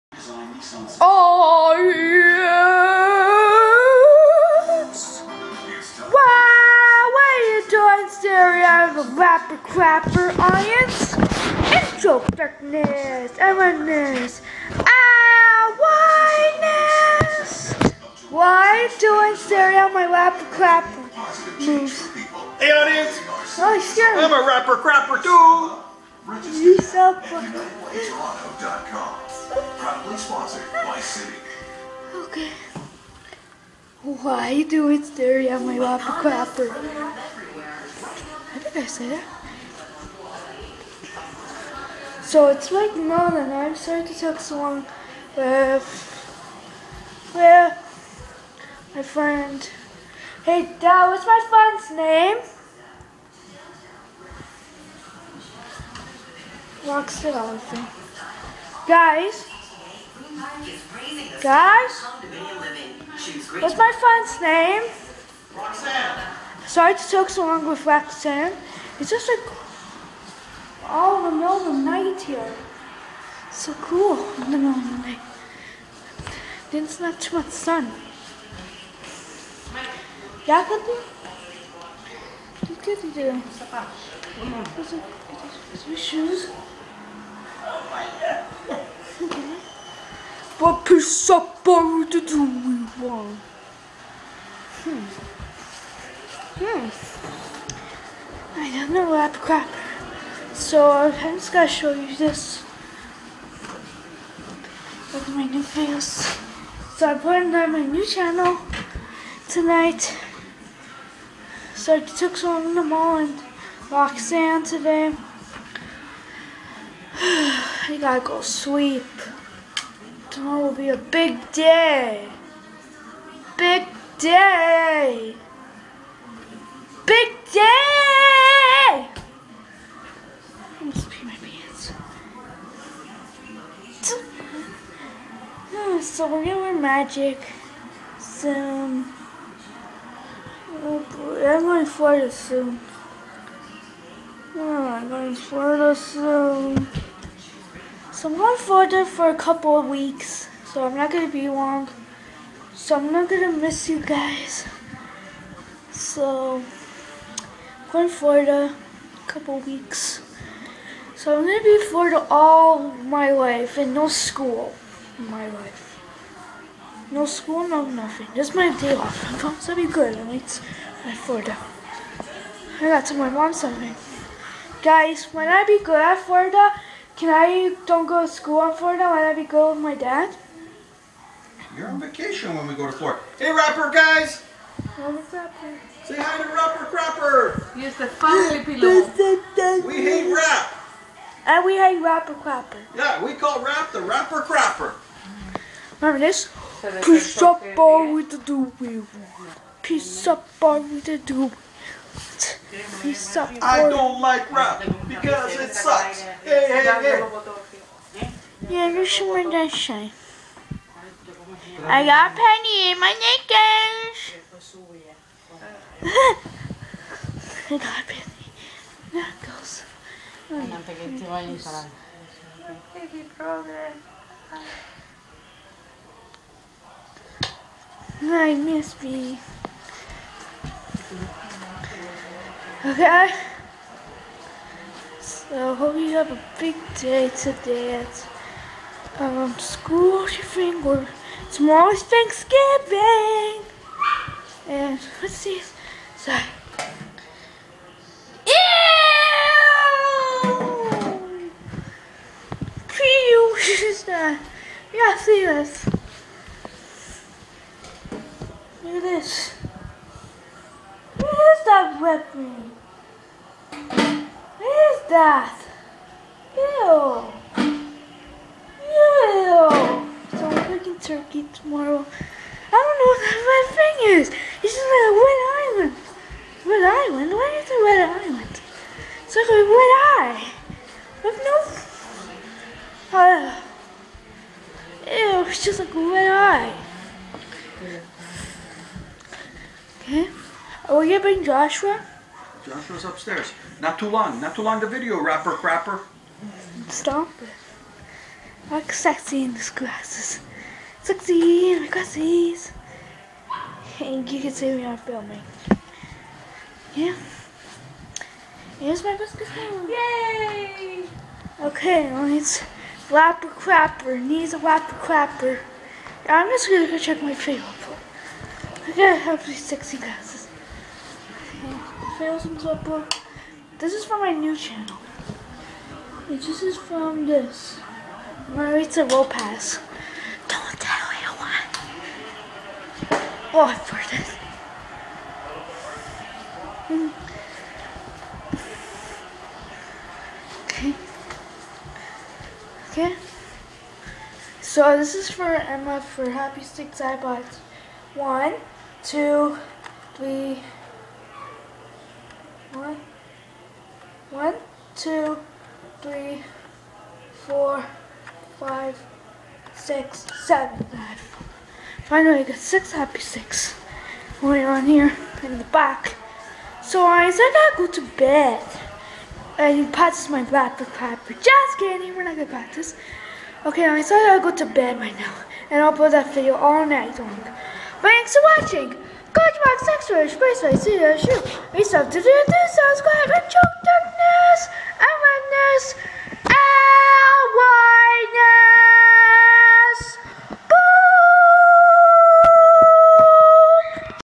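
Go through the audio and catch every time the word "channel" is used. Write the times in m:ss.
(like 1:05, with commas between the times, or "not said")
1:48, 5:24.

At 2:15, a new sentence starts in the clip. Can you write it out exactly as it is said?
Ah, so we're gonna wear magic.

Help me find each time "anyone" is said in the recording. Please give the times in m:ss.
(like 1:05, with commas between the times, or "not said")
5:31.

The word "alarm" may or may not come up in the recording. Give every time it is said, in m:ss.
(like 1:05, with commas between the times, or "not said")
not said.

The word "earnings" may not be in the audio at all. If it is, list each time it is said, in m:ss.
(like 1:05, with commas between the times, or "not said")
not said.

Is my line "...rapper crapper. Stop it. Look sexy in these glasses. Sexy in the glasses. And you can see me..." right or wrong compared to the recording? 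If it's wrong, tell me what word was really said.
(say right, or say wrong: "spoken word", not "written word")
right.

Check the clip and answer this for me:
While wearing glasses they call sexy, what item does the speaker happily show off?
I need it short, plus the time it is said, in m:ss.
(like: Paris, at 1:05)
Basketball, at 5:09.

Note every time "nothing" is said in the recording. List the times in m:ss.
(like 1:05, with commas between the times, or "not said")
2:47.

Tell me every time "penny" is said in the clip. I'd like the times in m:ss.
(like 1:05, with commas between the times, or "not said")
3:32, 3:38.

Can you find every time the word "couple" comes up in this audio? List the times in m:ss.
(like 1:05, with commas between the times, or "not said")
2:29, 2:39.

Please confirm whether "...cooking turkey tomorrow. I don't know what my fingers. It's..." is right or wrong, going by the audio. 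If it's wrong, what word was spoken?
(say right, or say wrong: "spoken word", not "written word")
right.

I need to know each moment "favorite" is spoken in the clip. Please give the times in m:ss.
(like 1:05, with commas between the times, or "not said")
5:17.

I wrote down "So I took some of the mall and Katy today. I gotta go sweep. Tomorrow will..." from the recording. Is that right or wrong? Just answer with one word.
wrong.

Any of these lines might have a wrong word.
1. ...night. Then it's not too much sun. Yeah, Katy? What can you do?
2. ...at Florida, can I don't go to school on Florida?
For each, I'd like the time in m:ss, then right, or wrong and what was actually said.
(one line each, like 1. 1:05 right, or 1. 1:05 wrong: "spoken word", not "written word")
1. 1:15 right
2. 2:55 right.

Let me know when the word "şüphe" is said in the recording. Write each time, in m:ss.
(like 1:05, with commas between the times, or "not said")
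6:20.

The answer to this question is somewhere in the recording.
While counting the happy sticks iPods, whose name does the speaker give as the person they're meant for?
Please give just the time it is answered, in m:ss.
5:45.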